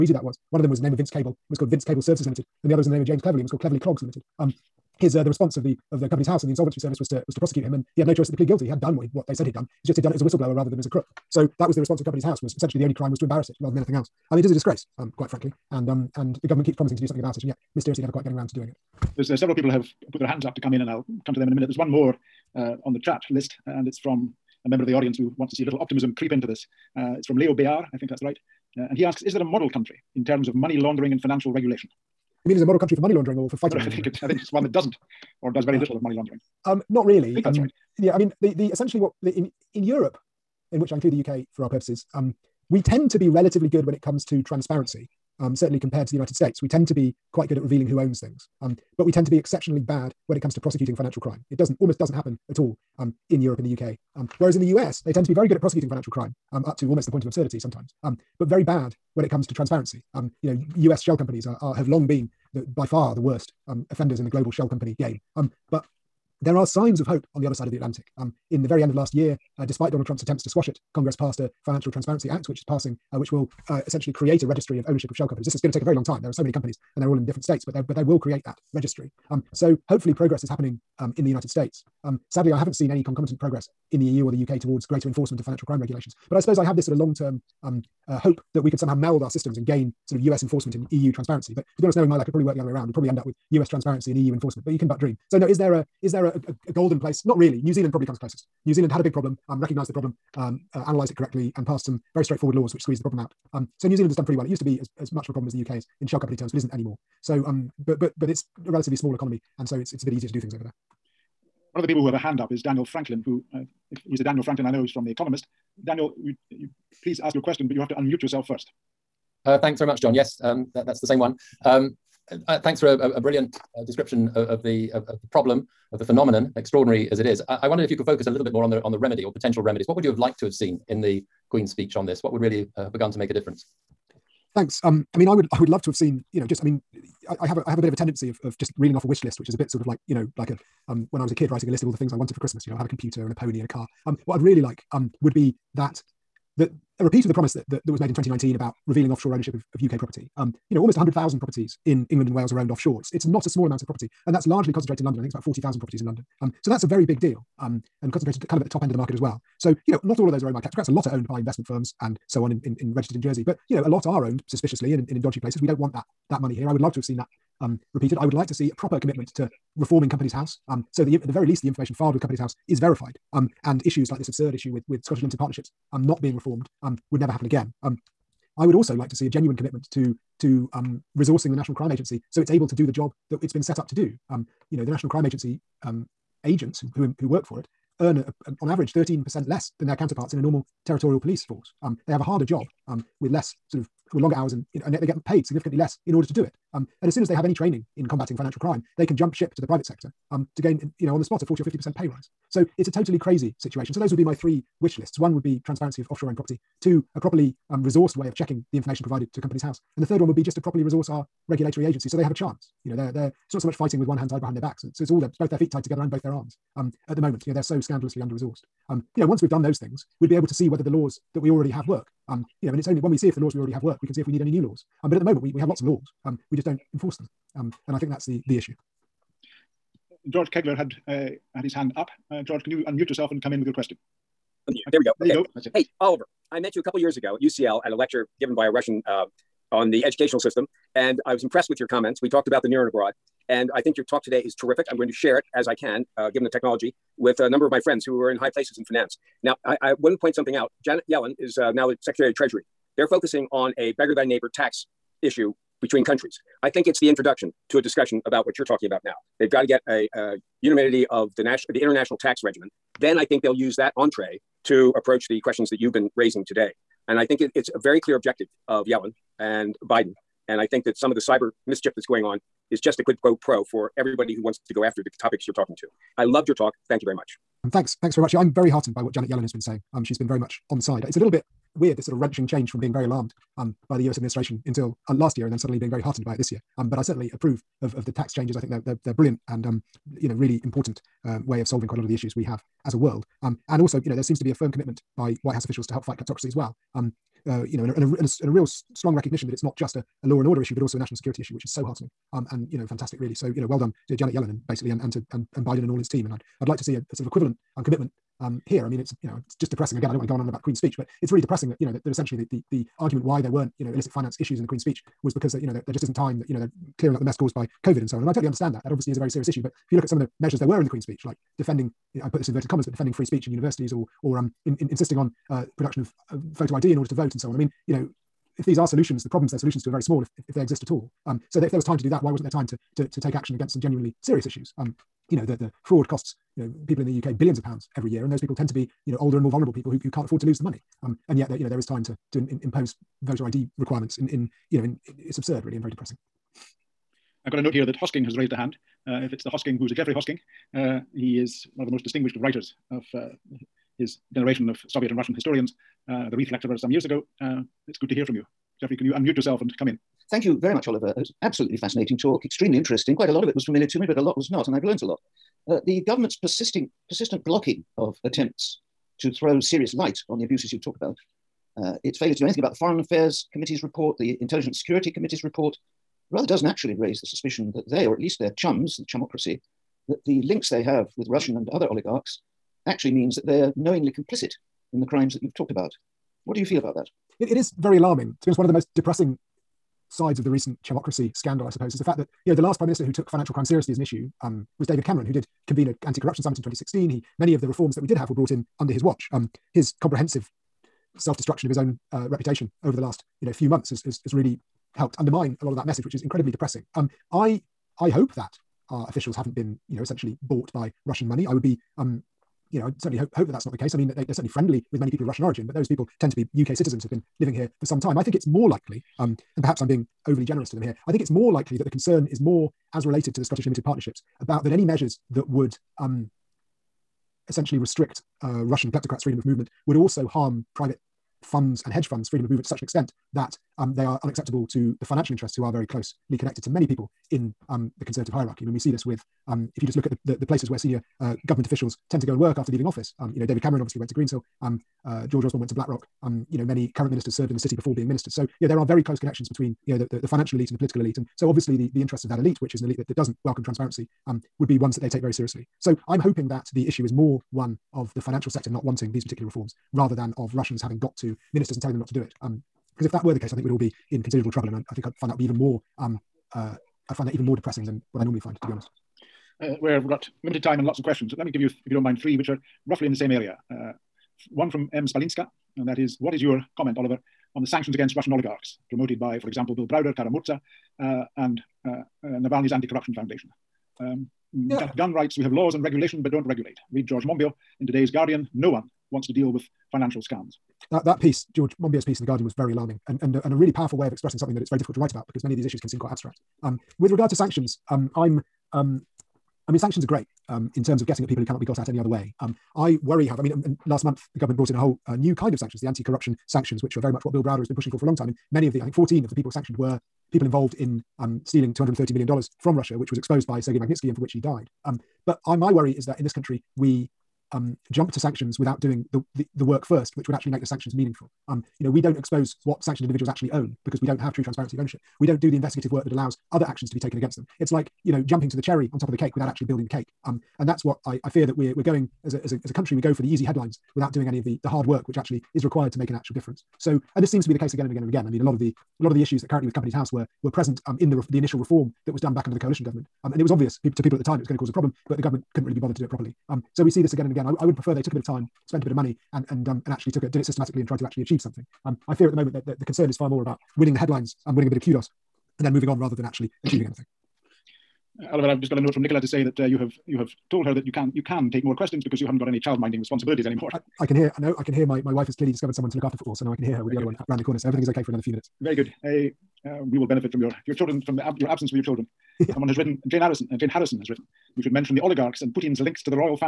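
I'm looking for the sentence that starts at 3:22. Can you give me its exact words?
So it's a totally crazy situation.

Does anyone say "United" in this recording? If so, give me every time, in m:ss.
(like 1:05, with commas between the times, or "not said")
0:46, 1:21.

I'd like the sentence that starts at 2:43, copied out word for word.
But, you know, a lot are owned suspiciously and in, in, in dodgy places.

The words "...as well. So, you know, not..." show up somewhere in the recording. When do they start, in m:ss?
2:39.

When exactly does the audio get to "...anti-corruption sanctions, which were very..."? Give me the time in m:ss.
8:25.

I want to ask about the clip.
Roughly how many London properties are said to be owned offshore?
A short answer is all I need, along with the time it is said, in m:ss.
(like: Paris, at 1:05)
40,000, at 2:35.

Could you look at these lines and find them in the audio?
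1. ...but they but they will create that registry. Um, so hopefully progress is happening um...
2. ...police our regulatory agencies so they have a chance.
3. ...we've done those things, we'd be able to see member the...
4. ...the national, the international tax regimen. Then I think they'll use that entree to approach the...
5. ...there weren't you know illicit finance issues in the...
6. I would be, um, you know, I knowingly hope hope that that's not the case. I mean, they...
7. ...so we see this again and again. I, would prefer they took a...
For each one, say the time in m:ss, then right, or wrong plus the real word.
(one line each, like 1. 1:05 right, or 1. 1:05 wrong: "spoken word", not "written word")
1. 1:17 right
2. 3:30 wrong: "resource", not "police"
3. 3:39 wrong: "whether", not "member"
4. 4:21 right
5. 5:13 right
6. 6:51 wrong: "certainly", not "knowingly"
7. 9:06 right.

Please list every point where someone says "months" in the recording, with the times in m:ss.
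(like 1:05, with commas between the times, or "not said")
6:43, 8:24.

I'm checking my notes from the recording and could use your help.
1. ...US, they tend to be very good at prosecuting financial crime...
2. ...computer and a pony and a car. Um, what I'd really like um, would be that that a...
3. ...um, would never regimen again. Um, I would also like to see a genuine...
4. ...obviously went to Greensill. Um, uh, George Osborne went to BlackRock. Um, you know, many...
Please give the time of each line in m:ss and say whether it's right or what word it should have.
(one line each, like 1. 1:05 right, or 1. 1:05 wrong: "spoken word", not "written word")
1. 0:54 right
2. 2:22 right
3. 2:56 wrong: "happen", not "regimen"
4. 7:23 right.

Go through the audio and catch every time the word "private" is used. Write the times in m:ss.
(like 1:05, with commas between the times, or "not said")
3:19, 7:10.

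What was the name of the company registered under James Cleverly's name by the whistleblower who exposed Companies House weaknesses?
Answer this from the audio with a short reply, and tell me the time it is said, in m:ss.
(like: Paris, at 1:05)
Cleverly Clogs Limited, at 0:03.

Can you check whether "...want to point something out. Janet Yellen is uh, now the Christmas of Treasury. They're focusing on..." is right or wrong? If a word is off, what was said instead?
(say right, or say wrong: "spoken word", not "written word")
wrong: "Secretary", not "Christmas".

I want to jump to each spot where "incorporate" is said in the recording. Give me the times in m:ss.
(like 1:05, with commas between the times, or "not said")
not said.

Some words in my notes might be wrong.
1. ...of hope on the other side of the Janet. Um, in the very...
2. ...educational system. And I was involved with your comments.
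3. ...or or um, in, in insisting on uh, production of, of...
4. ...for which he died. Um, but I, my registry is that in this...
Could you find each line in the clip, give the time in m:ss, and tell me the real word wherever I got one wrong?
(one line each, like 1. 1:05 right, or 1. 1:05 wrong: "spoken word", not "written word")
1. 1:06 wrong: "Atlantic", not "Janet"
2. 4:00 wrong: "impressed", not "involved"
3. 5:23 right
4. 8:34 wrong: "worry", not "registry".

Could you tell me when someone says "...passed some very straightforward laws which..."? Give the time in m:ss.
1:41.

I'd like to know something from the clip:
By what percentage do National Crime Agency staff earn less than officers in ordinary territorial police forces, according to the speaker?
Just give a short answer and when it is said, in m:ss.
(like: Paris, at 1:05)
13%, at 3:08.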